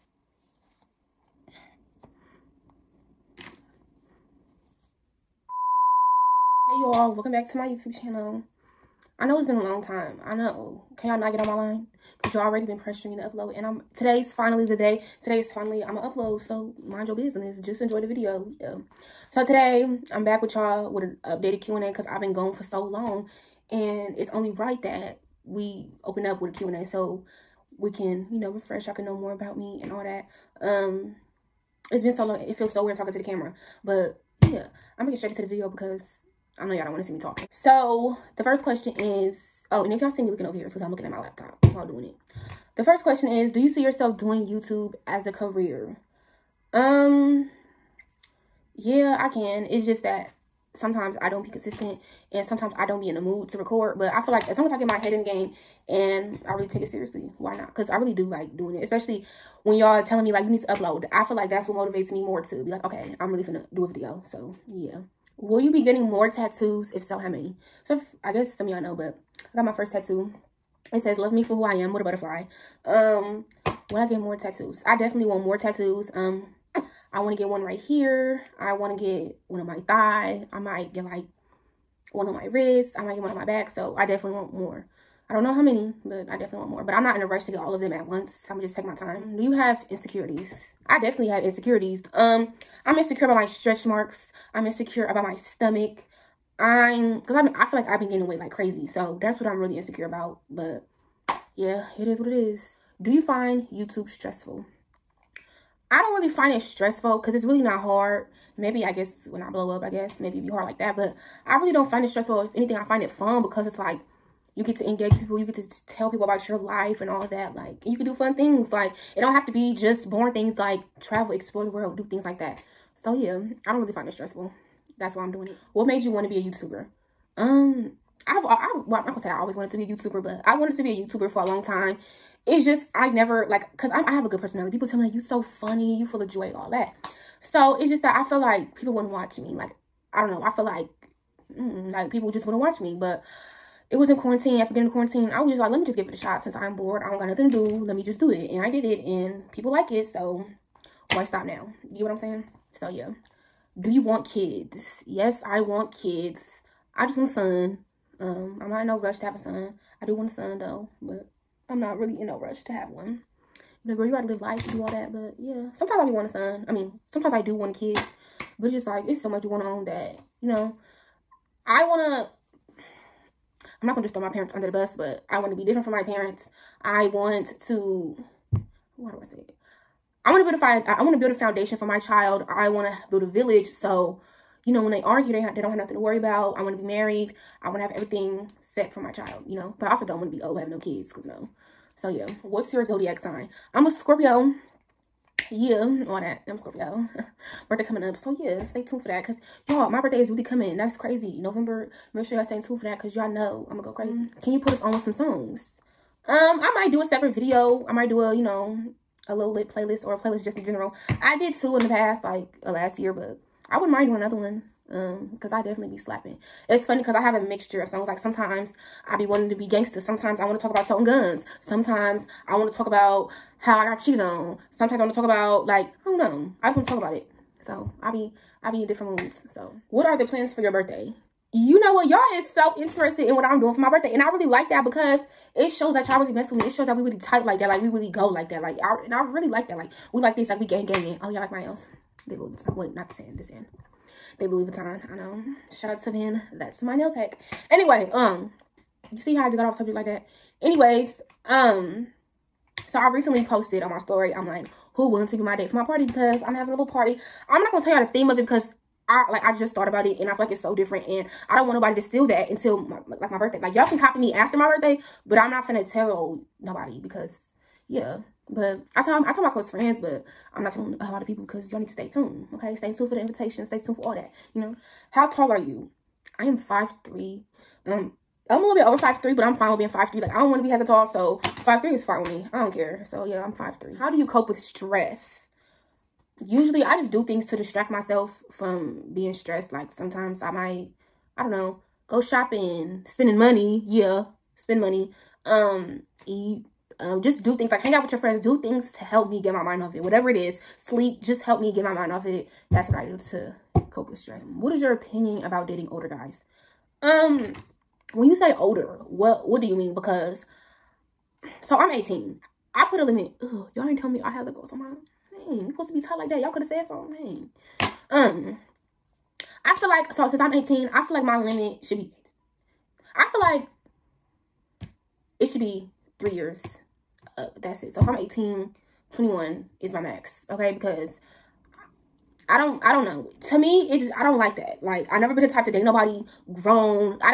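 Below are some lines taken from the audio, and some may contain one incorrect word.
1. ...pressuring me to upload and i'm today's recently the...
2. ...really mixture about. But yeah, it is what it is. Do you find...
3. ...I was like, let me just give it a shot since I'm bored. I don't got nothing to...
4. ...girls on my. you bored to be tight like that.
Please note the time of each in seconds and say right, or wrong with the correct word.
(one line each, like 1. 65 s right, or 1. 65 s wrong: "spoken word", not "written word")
1. 12 s wrong: "finally", not "recently"
2. 99 s wrong: "insecure", not "mixture"
3. 145 s right
4. 314 s wrong: "supposed", not "bored".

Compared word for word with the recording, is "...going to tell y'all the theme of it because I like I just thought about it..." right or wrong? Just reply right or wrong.
right.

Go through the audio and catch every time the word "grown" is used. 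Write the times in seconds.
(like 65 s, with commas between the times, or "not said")
336 s.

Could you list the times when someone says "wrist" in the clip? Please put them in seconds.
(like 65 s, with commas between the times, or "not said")
82 s.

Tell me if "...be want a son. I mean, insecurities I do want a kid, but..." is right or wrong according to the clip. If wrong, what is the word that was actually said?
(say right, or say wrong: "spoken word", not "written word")
wrong: "sometimes", not "insecurities".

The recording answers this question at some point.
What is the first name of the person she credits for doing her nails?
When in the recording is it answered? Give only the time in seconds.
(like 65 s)
245 s.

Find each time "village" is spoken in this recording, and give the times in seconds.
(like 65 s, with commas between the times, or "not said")
183 s.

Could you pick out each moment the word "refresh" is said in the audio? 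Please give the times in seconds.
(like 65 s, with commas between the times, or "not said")
28 s.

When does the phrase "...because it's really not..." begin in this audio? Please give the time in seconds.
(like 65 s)
107 s.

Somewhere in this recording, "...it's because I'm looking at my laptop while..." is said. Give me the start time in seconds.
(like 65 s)
40 s.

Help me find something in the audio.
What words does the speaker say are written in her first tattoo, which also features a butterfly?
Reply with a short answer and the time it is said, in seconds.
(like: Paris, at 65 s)
Love me for who I am, at 71 s.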